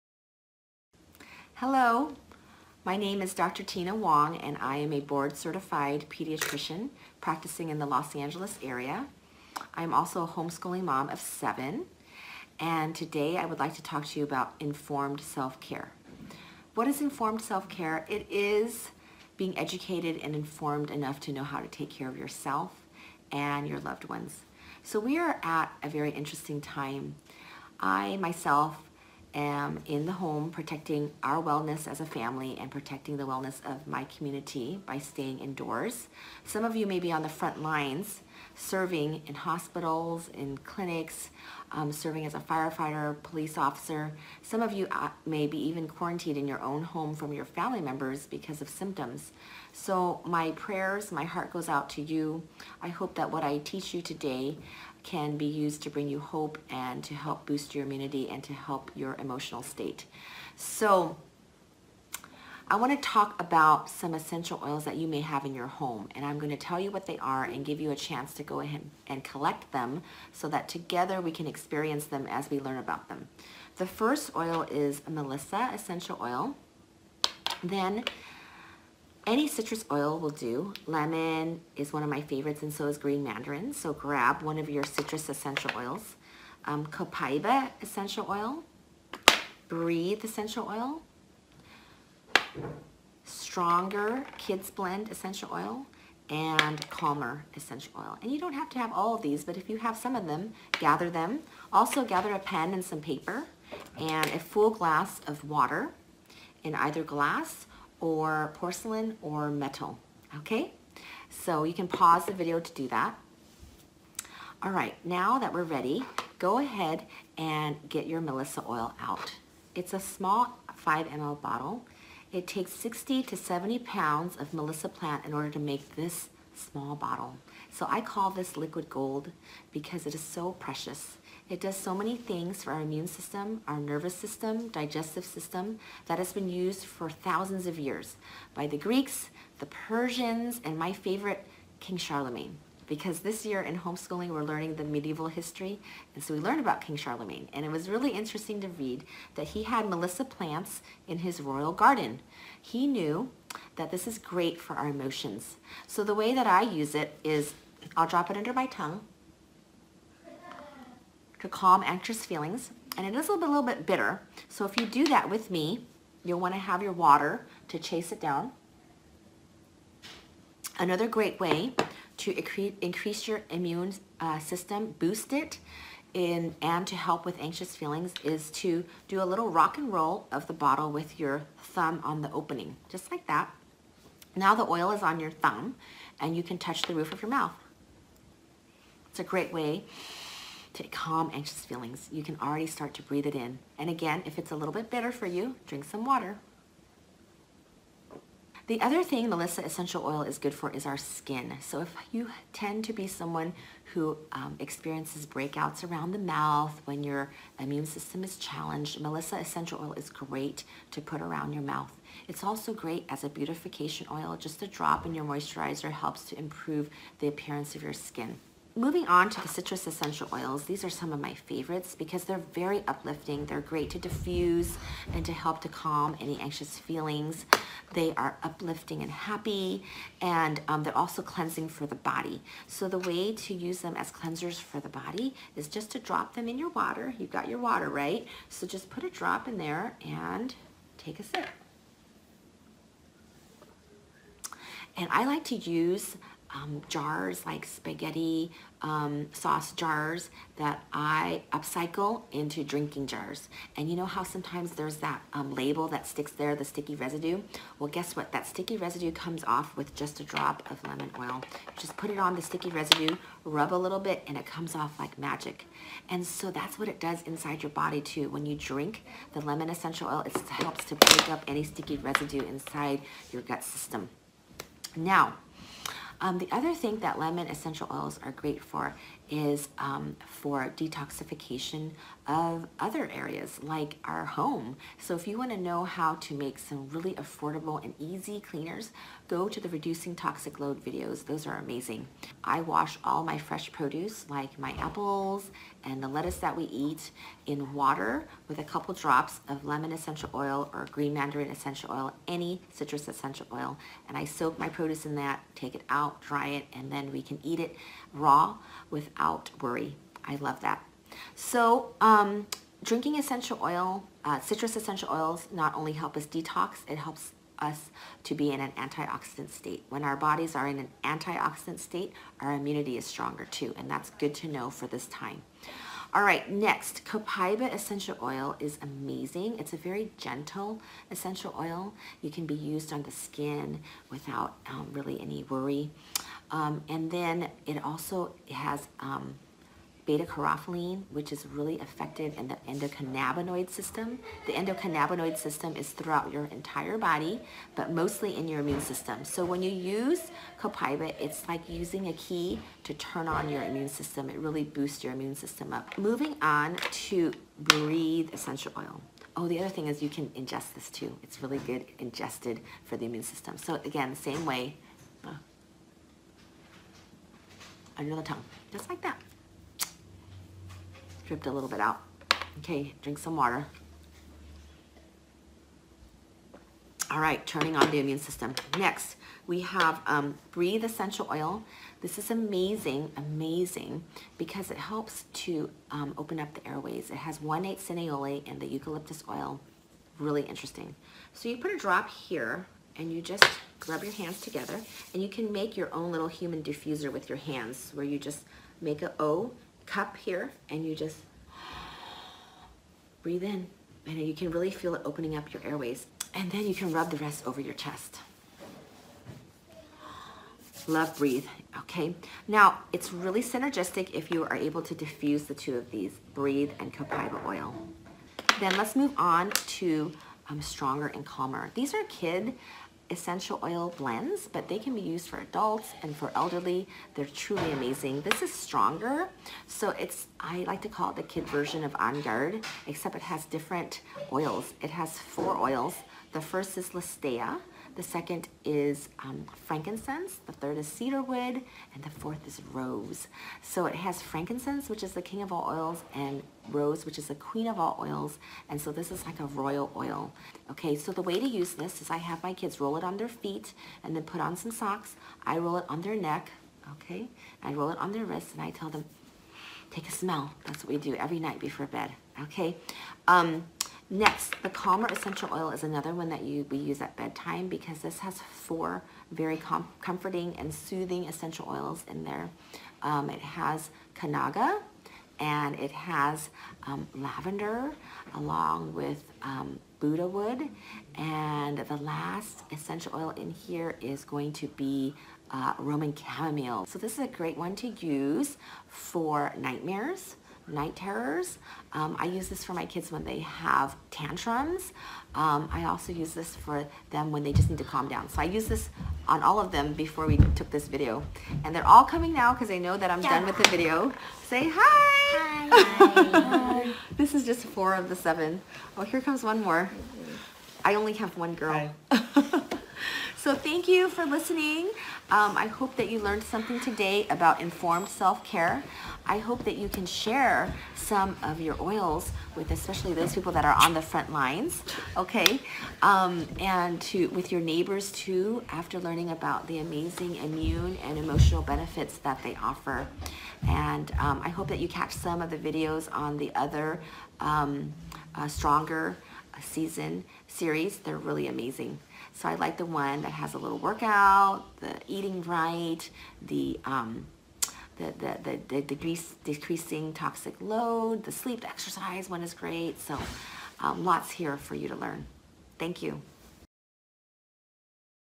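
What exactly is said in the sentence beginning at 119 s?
It's a small 5 ml bottle it takes 60 to 70 pounds of Melissa plant in order to make this small bottle.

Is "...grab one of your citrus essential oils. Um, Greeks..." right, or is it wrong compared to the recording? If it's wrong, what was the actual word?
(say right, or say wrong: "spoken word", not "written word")
wrong: "Copaiba", not "Greeks".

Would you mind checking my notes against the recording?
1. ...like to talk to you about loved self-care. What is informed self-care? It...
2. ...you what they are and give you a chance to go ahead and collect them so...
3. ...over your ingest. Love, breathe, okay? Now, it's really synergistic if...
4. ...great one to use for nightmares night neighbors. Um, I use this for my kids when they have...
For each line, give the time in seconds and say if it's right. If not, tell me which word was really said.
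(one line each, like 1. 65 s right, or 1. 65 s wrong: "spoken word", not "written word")
1. 13 s wrong: "informed", not "loved"
2. 66 s right
3. 407 s wrong: "chest", not "ingest"
4. 487 s wrong: "terrors", not "neighbors".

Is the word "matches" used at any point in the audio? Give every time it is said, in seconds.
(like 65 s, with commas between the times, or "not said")
not said.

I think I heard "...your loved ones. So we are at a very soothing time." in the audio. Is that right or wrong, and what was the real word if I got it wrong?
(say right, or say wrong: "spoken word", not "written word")
wrong: "interesting", not "soothing".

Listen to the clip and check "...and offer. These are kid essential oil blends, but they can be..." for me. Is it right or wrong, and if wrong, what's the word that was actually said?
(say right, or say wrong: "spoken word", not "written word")
wrong: "calmer", not "offer".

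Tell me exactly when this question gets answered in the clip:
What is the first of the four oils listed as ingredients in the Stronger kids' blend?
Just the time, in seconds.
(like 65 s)
436 s.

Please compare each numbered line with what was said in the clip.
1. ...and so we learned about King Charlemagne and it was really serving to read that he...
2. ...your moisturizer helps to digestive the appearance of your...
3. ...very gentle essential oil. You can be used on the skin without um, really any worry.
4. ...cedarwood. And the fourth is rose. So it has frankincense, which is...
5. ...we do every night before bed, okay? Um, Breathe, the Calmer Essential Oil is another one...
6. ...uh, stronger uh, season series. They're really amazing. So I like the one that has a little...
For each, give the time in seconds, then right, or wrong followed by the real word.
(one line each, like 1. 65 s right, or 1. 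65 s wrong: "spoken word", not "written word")
1. 146 s wrong: "interesting", not "serving"
2. 215 s wrong: "improve", not "digestive"
3. 329 s right
4. 440 s right
5. 460 s wrong: "Next", not "Breathe"
6. 538 s right.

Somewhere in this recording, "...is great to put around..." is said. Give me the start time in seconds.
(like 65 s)
209 s.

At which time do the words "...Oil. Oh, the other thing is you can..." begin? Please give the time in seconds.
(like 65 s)
358 s.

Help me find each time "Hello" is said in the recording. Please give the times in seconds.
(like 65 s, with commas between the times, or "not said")
1 s.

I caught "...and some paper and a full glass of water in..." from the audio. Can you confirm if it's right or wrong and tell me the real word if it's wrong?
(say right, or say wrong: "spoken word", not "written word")
right.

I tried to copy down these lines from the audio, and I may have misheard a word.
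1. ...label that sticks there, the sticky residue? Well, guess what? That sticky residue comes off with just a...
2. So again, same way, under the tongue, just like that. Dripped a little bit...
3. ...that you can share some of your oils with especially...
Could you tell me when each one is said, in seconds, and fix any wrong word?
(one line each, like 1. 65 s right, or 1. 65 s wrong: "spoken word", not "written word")
1. 255 s right
2. 363 s right
3. 519 s right.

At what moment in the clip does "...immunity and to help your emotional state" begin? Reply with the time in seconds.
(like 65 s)
57 s.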